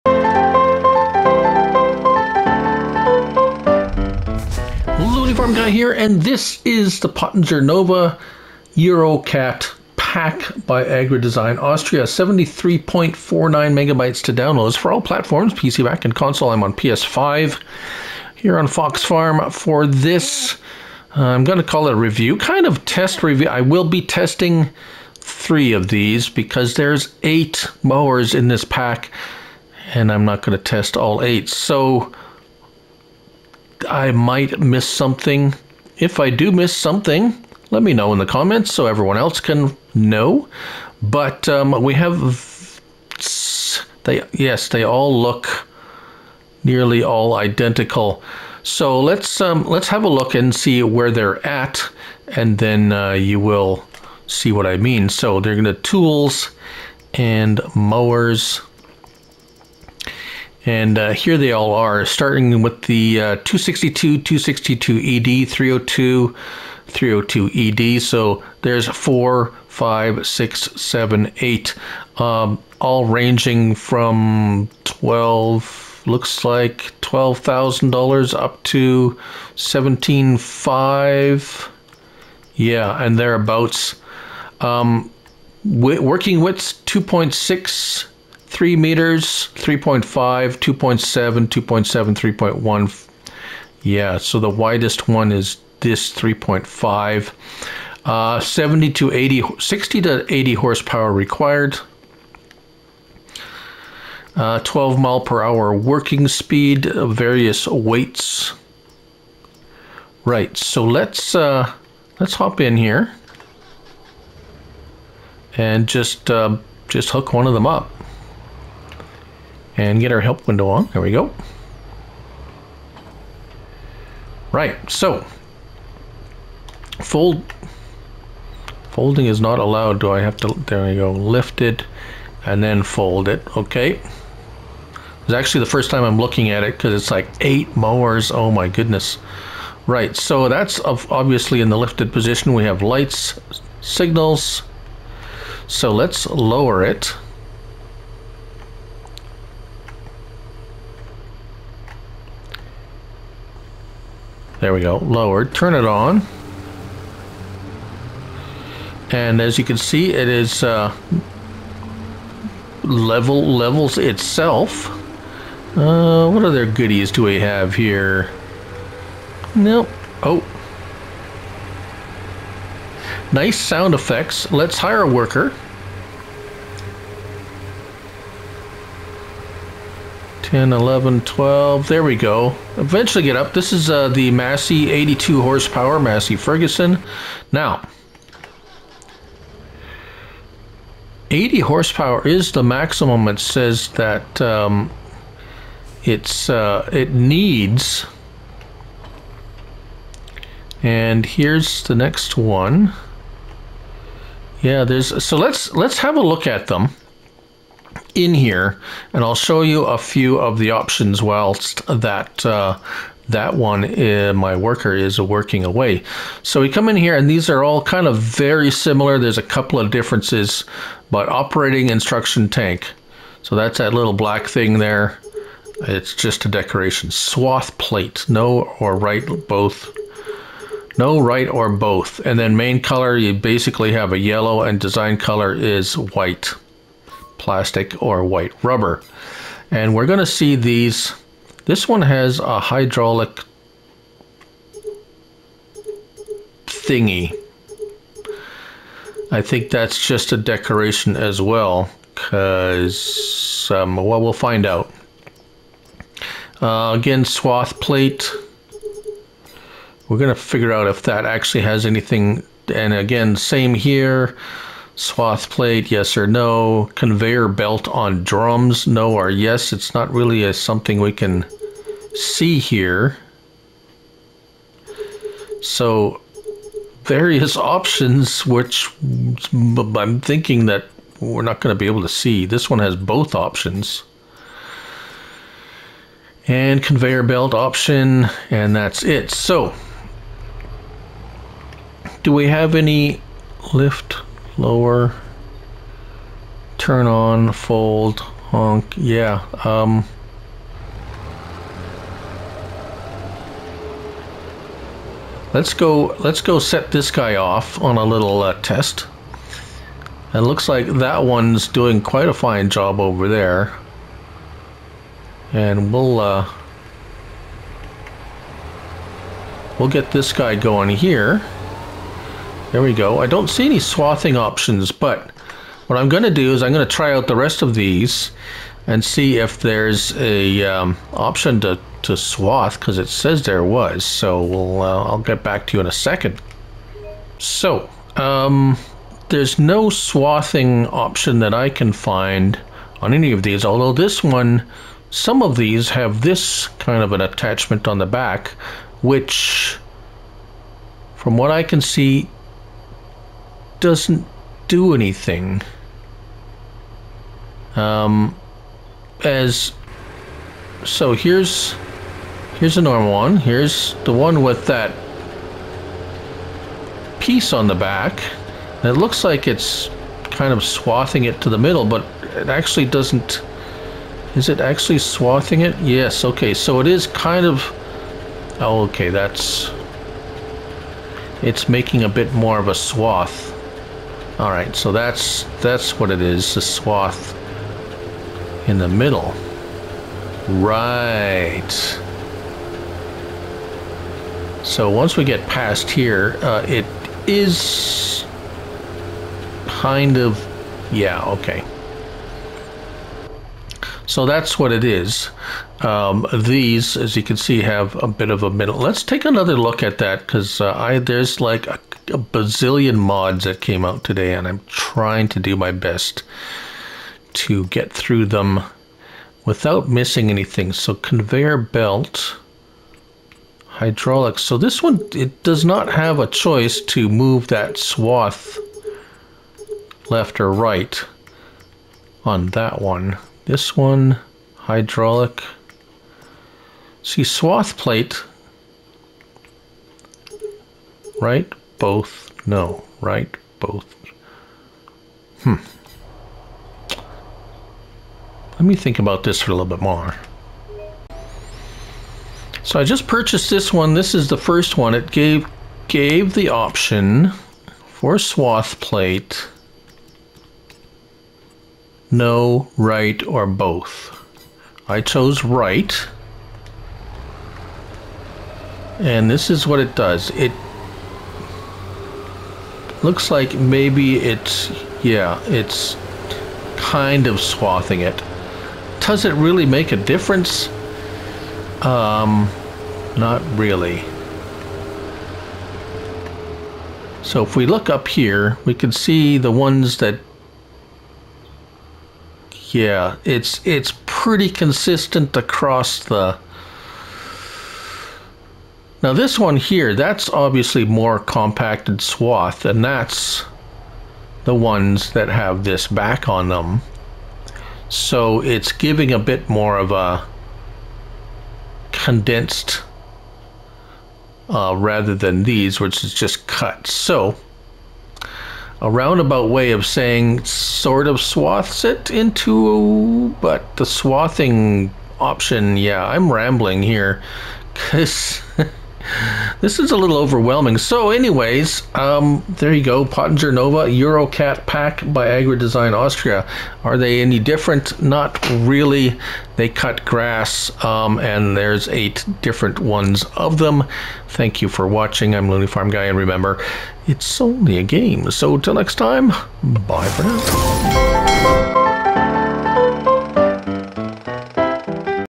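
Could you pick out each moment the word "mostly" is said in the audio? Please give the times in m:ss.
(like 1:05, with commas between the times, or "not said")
not said.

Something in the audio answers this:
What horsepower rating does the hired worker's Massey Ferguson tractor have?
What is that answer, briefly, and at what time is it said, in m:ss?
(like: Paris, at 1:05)
82, at 3:04.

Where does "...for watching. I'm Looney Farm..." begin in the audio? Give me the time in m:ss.
9:04.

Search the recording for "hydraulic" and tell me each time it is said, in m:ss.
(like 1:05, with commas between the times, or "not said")
4:02, 7:03, 7:14.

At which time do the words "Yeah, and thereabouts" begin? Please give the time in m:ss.
1:22.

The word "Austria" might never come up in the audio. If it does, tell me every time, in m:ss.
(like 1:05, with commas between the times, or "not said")
0:11, 8:55.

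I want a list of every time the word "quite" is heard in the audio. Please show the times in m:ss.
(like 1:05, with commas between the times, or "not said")
5:12.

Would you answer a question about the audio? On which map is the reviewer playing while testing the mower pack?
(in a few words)
Fox Farm.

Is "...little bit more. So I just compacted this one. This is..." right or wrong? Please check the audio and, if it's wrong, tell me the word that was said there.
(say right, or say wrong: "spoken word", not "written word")
wrong: "purchased", not "compacted".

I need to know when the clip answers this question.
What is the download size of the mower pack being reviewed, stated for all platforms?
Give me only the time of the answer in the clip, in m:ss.
0:12.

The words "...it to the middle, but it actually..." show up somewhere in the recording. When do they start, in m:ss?
6:11.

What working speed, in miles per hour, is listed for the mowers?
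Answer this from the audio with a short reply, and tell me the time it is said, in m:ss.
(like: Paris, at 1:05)
12 mph, at 1:44.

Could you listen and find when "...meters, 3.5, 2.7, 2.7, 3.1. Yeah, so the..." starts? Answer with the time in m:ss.
1:28.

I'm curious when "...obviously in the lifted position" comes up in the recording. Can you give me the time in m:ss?
2:20.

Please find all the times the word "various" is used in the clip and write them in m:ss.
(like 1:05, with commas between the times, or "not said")
1:47, 4:37.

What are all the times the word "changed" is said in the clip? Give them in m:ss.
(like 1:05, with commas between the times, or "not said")
not said.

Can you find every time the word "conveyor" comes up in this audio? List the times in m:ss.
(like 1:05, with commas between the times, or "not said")
4:26, 4:46, 7:00.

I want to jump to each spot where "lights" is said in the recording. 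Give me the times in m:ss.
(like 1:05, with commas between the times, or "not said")
2:22.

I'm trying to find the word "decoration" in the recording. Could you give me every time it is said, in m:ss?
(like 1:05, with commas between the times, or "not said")
3:46, 4:10.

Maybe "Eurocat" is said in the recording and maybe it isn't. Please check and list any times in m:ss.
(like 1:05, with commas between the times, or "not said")
0:08, 8:53.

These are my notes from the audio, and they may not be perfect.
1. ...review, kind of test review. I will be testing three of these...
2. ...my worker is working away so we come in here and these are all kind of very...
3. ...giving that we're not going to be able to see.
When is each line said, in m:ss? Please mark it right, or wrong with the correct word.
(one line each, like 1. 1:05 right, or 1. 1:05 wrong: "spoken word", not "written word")
1. 0:21 right
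2. 3:34 right
3. 4:40 wrong: "thinking", not "giving".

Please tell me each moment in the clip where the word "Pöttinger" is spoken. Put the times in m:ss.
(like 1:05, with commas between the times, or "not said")
0:07, 8:53.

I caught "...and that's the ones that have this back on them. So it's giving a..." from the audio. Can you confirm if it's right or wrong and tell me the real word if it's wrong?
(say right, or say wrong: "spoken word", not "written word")
right.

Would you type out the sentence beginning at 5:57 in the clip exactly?
Um, as so here's here's a normal one.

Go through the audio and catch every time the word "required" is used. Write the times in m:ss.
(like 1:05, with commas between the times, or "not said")
1:41.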